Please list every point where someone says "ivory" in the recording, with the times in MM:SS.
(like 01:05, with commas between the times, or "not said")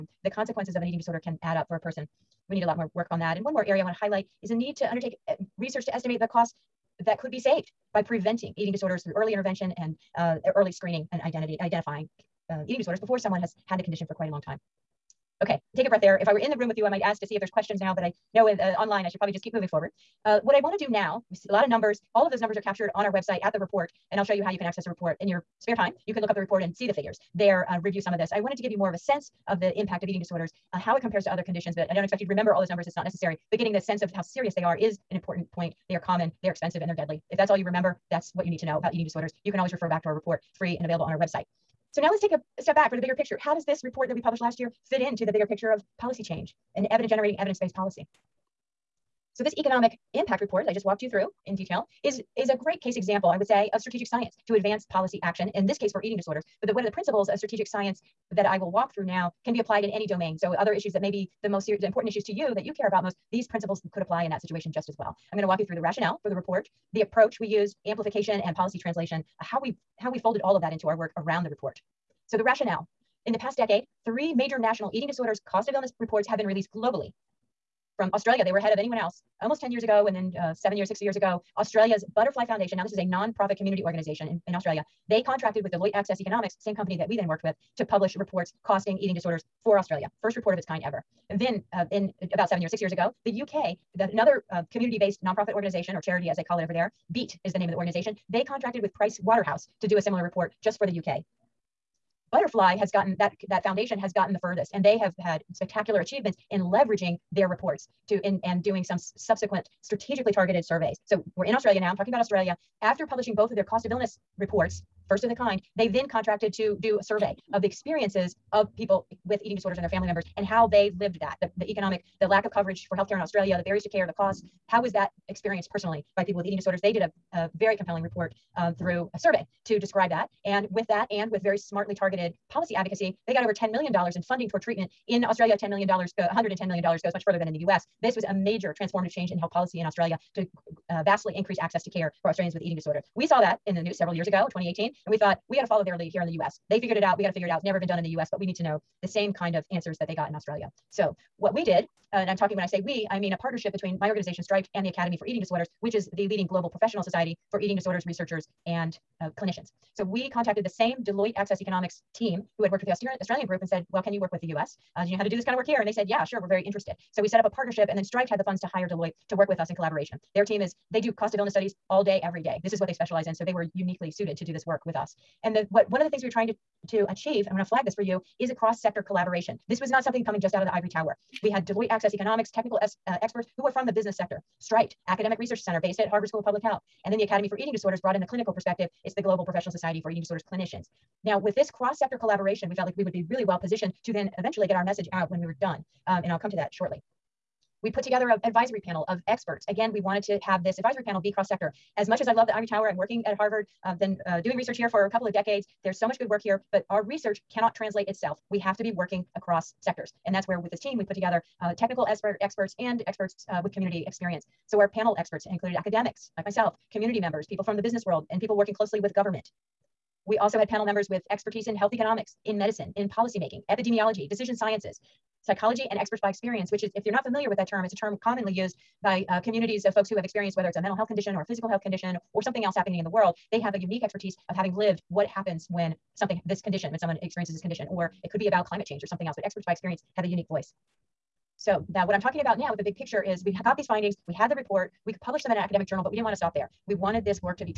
03:00, 03:22.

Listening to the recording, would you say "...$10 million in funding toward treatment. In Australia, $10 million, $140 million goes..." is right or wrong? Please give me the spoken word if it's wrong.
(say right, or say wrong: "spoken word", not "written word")
wrong: "110", not "140".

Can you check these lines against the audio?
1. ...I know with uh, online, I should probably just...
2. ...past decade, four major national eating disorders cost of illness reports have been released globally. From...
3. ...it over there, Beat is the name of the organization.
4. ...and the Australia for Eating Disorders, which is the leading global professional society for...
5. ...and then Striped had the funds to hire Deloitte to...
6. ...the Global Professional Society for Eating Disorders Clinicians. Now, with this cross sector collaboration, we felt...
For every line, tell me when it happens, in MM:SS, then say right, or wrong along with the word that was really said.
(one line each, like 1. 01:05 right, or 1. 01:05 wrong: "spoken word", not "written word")
1. 00:18 right
2. 01:13 wrong: "three", not "four"
3. 01:36 right
4. 02:34 wrong: "Academy", not "Australia"
5. 02:47 right
6. 03:09 right.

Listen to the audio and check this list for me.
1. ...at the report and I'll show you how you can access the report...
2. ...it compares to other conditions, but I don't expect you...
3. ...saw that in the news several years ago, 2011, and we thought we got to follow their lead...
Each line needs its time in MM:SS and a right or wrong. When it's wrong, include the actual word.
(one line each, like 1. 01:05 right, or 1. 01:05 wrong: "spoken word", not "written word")
1. 00:23 right
2. 00:30 right
3. 02:23 wrong: "2018", not "2011".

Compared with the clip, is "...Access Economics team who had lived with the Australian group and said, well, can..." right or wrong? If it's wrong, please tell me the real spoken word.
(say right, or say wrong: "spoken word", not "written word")
wrong: "worked", not "lived".